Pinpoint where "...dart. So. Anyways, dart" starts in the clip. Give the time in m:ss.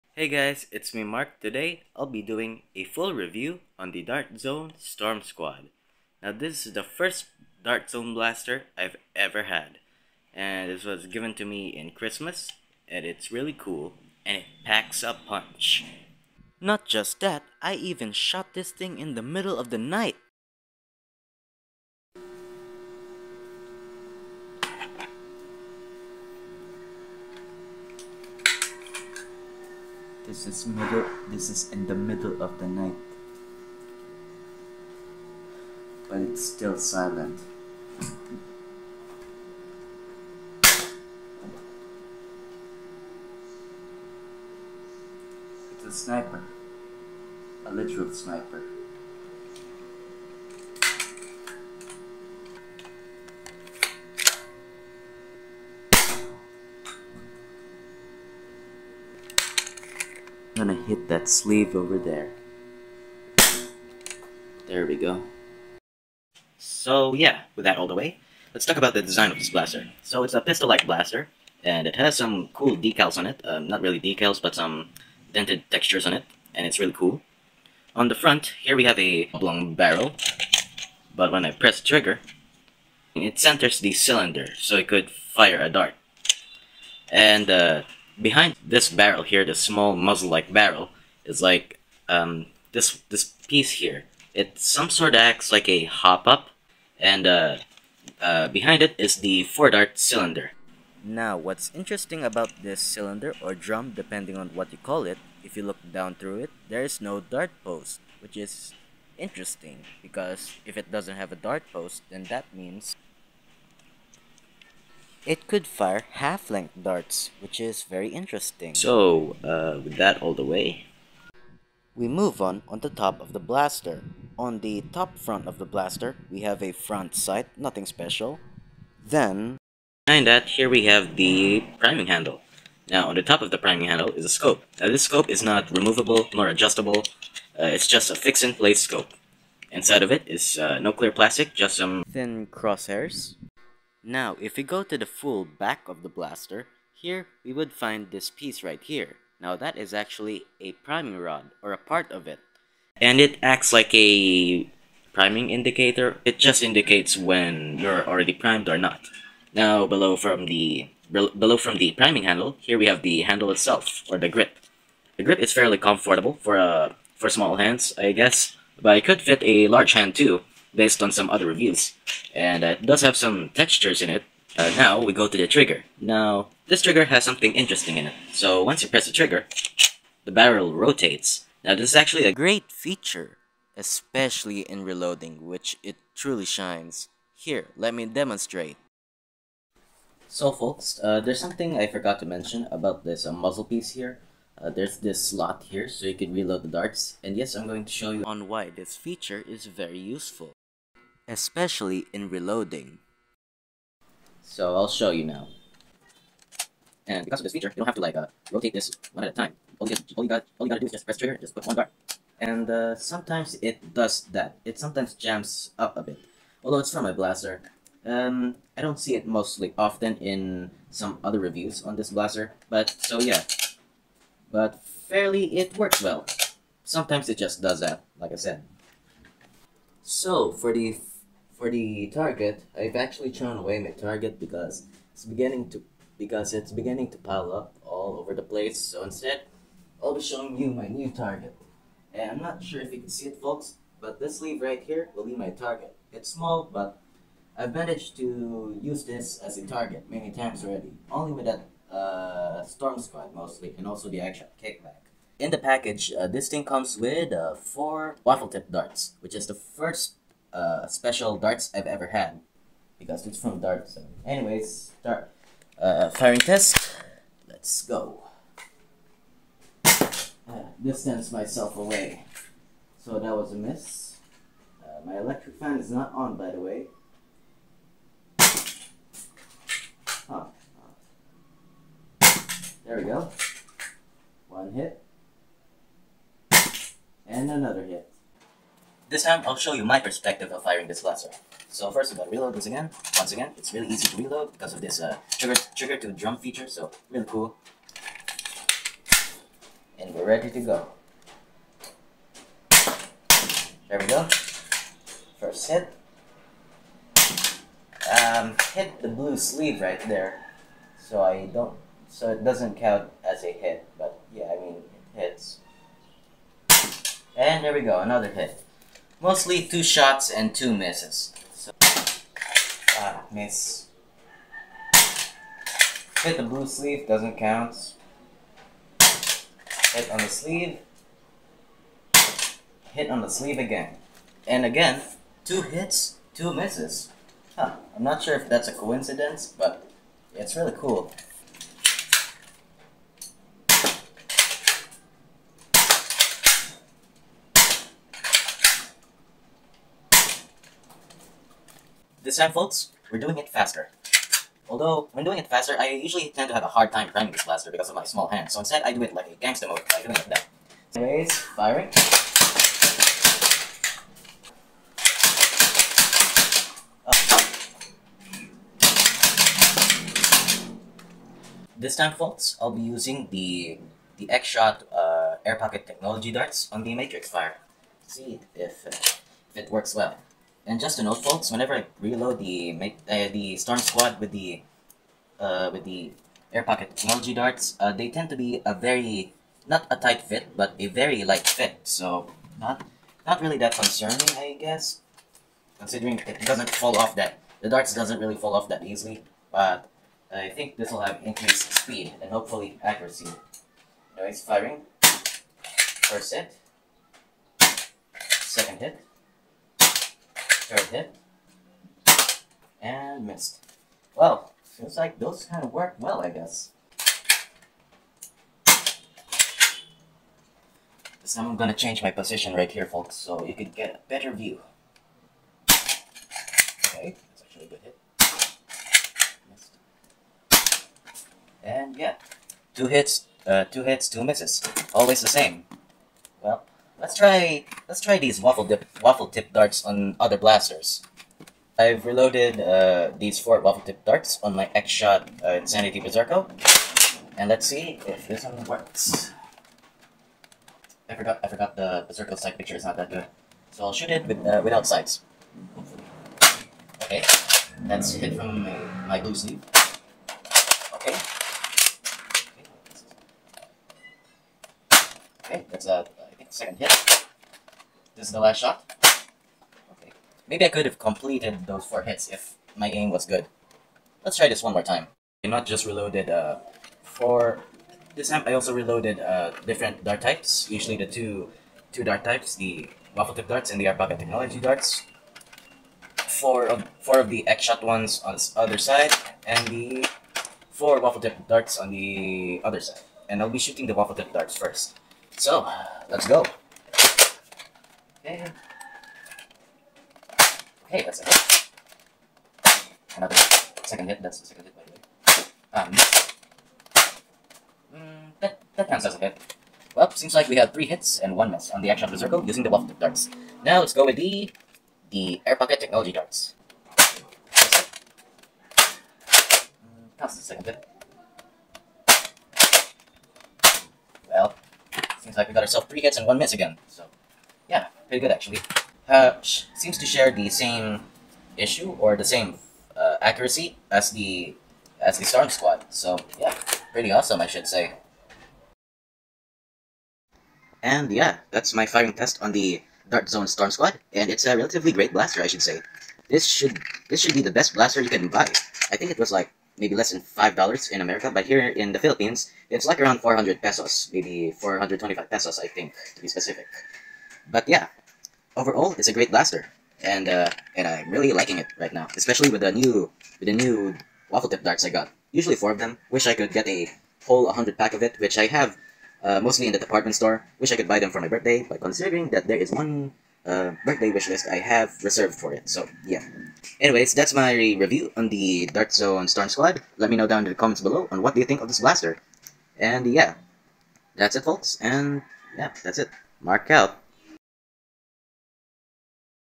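4:23.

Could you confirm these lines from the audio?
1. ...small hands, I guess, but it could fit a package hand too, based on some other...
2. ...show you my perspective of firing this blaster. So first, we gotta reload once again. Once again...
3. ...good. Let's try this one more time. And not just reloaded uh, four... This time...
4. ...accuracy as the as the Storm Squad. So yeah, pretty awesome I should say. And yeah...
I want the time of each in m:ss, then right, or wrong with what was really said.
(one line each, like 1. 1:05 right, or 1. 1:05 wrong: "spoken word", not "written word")
1. 2:47 wrong: "large", not "package"
2. 4:49 right
3. 7:53 right
4. 8:53 right.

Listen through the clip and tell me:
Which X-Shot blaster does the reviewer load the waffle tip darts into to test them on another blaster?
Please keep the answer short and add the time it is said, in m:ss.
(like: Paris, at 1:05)
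Insanity Berserko, at 7:25.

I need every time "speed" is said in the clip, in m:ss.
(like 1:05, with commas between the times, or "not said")
6:41.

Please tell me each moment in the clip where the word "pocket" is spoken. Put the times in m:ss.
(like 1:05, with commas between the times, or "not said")
6:15, 6:26, 8:03, 8:35.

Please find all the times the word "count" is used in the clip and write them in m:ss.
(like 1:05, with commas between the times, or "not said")
5:12, 5:27, 8:28.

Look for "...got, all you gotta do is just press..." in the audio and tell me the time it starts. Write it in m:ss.
3:30.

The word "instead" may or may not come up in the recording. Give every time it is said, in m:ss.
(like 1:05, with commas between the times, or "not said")
3:59, 5:58.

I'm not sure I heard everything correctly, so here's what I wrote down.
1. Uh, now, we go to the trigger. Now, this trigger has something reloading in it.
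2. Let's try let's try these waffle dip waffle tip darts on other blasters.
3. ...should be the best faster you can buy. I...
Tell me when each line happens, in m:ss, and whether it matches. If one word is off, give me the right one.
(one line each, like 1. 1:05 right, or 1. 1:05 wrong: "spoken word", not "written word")
1. 2:54 wrong: "interesting", not "reloading"
2. 7:17 right
3. 9:07 wrong: "blaster", not "faster".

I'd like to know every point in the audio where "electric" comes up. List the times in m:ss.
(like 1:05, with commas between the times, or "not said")
4:35.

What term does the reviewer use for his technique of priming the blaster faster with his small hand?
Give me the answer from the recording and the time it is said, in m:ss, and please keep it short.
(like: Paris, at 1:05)
gangster mode, at 5:59.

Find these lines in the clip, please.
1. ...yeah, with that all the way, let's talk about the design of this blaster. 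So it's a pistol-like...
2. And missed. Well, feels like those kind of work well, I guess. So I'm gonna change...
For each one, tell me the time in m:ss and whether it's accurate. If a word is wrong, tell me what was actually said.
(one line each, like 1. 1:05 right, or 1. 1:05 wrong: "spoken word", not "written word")
1. 1:07 right
2. 6:52 right.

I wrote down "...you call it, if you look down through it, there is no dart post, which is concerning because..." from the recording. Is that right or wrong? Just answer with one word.
wrong.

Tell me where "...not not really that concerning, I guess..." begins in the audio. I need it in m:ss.
6:32.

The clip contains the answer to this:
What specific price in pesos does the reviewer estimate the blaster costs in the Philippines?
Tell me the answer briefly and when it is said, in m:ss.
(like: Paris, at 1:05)
425 pesos, at 9:14.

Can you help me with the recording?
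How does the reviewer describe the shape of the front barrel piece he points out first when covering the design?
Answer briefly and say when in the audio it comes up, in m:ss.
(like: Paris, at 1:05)
oblong, at 1:19.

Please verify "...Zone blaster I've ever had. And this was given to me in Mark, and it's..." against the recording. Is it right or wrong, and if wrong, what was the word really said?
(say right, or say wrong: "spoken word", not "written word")
wrong: "Christmas", not "Mark".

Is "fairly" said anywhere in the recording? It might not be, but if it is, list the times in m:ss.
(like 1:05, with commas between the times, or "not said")
2:45, 3:44.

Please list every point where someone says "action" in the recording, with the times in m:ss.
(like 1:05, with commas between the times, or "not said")
4:14, 8:31.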